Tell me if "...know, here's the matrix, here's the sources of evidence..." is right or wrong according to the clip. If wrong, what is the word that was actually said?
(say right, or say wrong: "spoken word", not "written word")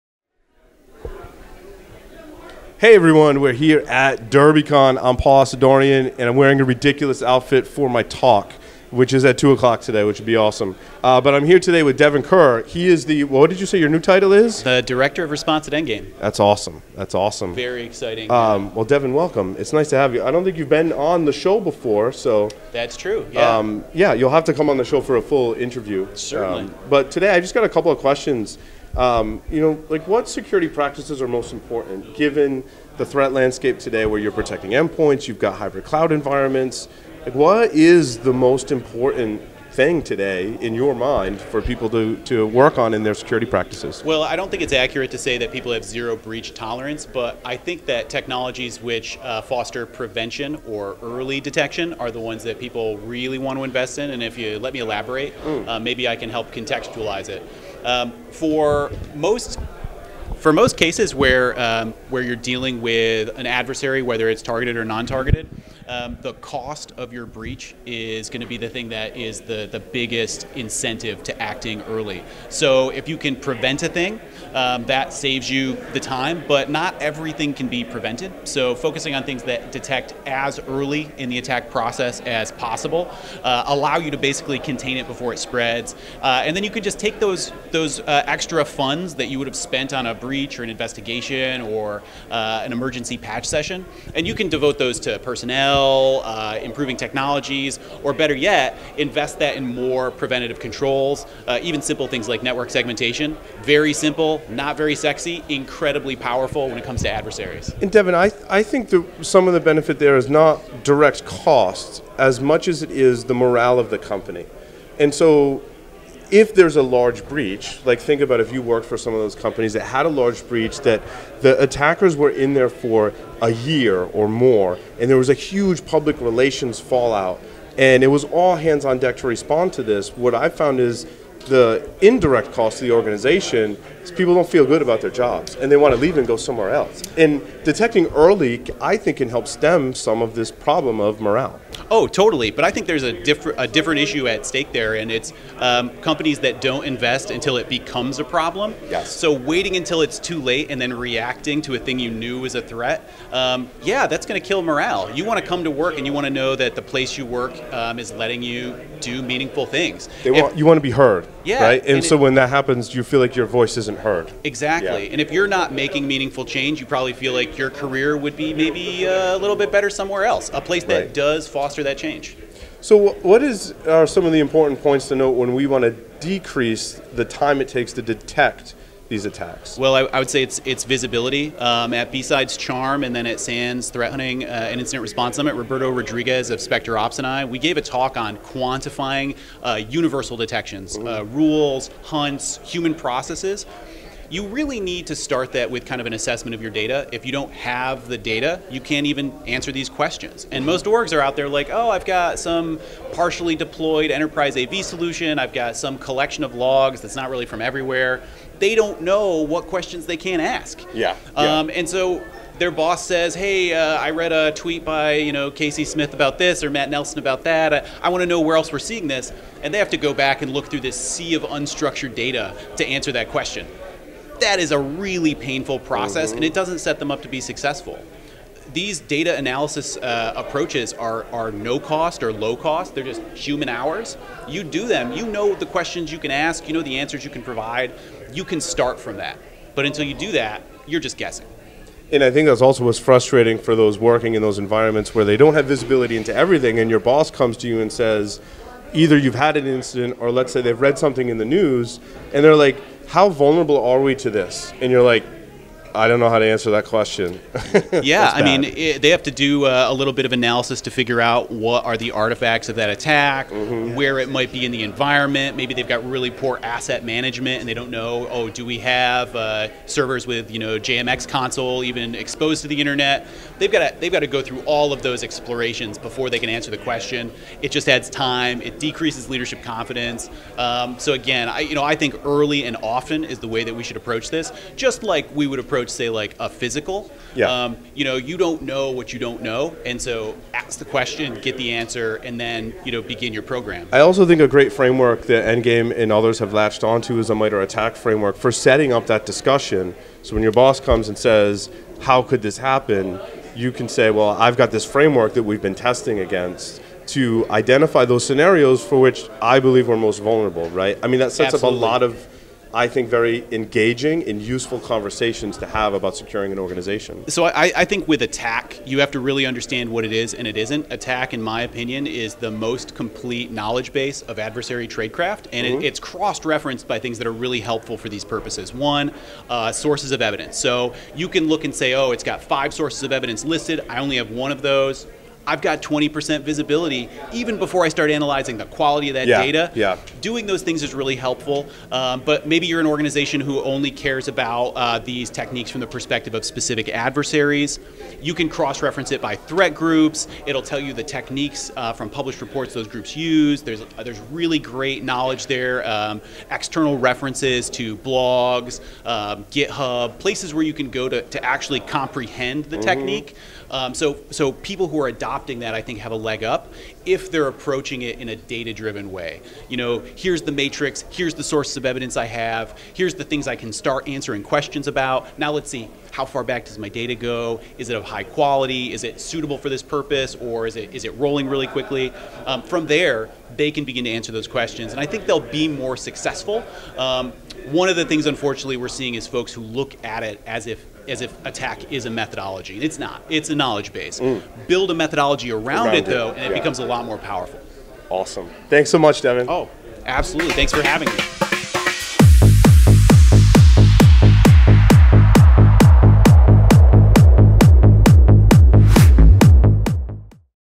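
right.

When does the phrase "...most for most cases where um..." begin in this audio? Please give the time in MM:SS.
00:59.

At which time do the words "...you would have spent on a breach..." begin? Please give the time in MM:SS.
01:29.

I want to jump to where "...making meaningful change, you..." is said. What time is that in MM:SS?
02:45.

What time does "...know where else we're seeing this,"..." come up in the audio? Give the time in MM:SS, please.
03:38.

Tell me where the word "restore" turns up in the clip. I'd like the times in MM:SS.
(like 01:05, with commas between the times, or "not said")
not said.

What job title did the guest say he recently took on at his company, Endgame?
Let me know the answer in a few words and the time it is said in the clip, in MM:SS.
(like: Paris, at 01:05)
Director of Response, at 00:14.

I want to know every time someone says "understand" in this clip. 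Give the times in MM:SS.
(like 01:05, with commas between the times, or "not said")
05:19.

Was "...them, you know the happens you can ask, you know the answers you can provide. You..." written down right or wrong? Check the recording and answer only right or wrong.
wrong.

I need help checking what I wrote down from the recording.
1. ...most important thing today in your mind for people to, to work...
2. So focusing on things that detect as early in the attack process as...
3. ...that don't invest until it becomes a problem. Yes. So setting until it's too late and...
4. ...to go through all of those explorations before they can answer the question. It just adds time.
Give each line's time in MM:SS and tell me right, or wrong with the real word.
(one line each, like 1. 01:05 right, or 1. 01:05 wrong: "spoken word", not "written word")
1. 00:38 right
2. 01:18 right
3. 02:26 wrong: "waiting", not "setting"
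4. 04:34 right.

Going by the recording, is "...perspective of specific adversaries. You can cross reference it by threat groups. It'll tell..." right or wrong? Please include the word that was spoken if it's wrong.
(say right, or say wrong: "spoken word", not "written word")
right.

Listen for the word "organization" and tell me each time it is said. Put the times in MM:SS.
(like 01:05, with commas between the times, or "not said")
02:12, 05:16, 05:42.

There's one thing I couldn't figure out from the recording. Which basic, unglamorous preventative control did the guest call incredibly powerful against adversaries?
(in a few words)
network segmentation.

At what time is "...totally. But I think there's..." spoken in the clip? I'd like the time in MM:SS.
02:22.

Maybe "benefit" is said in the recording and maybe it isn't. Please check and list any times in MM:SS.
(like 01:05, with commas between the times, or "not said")
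01:49.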